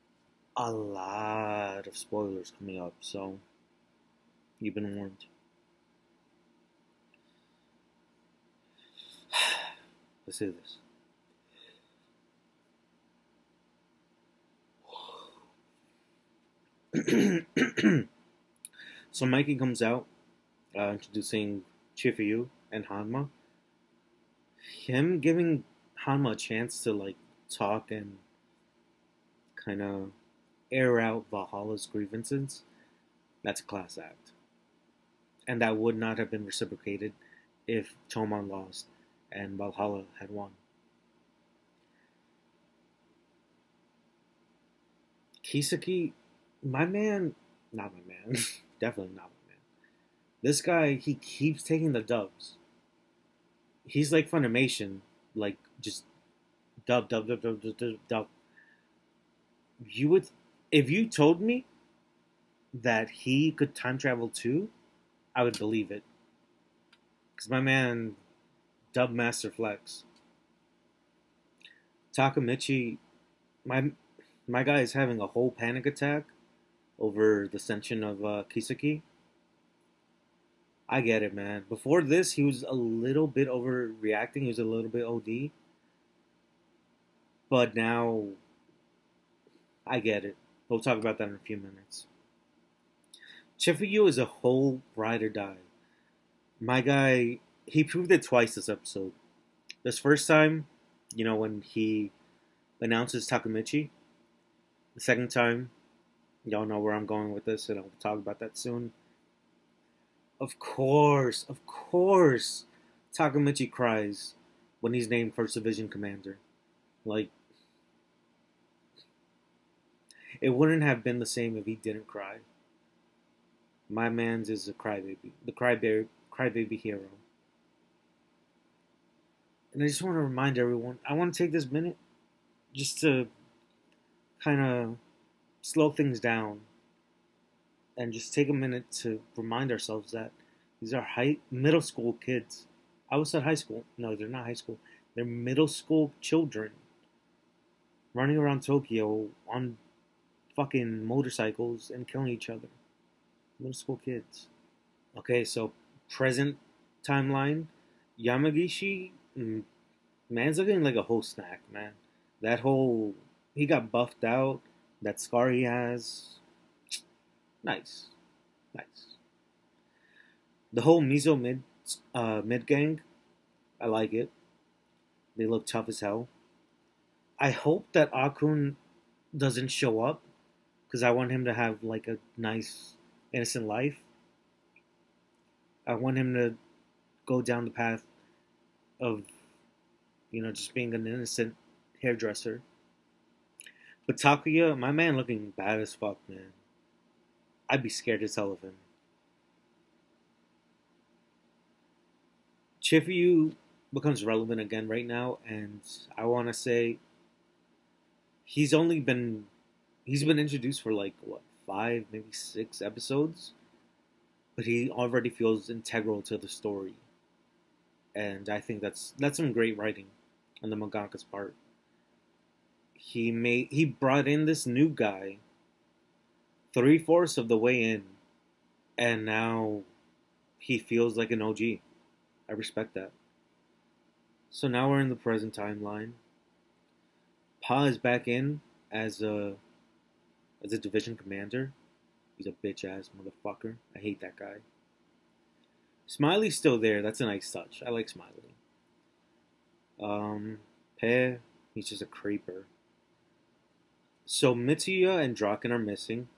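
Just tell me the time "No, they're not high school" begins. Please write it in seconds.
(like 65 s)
143 s.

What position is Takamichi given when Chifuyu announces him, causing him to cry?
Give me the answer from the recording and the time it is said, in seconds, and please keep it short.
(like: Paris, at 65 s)
First Division Commander, at 115 s.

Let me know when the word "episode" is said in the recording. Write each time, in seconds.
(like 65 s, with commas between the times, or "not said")
98 s, 212 s.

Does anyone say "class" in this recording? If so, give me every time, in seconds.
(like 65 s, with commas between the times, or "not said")
33 s.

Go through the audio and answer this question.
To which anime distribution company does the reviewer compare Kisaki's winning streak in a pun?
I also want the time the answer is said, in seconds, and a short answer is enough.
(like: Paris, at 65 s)
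Funimation, at 54 s.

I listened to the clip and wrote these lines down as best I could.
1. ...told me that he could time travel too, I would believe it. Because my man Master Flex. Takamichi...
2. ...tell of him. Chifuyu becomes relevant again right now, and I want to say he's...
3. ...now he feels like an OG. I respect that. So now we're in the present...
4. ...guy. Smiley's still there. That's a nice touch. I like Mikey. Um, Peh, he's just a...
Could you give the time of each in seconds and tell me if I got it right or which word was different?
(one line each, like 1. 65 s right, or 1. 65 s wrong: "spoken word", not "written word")
1. 61 s right
2. 198 s right
3. 229 s right
4. 244 s wrong: "Smiley", not "Mikey".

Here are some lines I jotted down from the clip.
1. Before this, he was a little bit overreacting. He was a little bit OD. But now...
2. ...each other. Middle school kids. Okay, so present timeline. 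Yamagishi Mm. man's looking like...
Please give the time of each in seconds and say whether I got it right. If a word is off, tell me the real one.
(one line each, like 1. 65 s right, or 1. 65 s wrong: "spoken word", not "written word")
1. 81 s right
2. 152 s right.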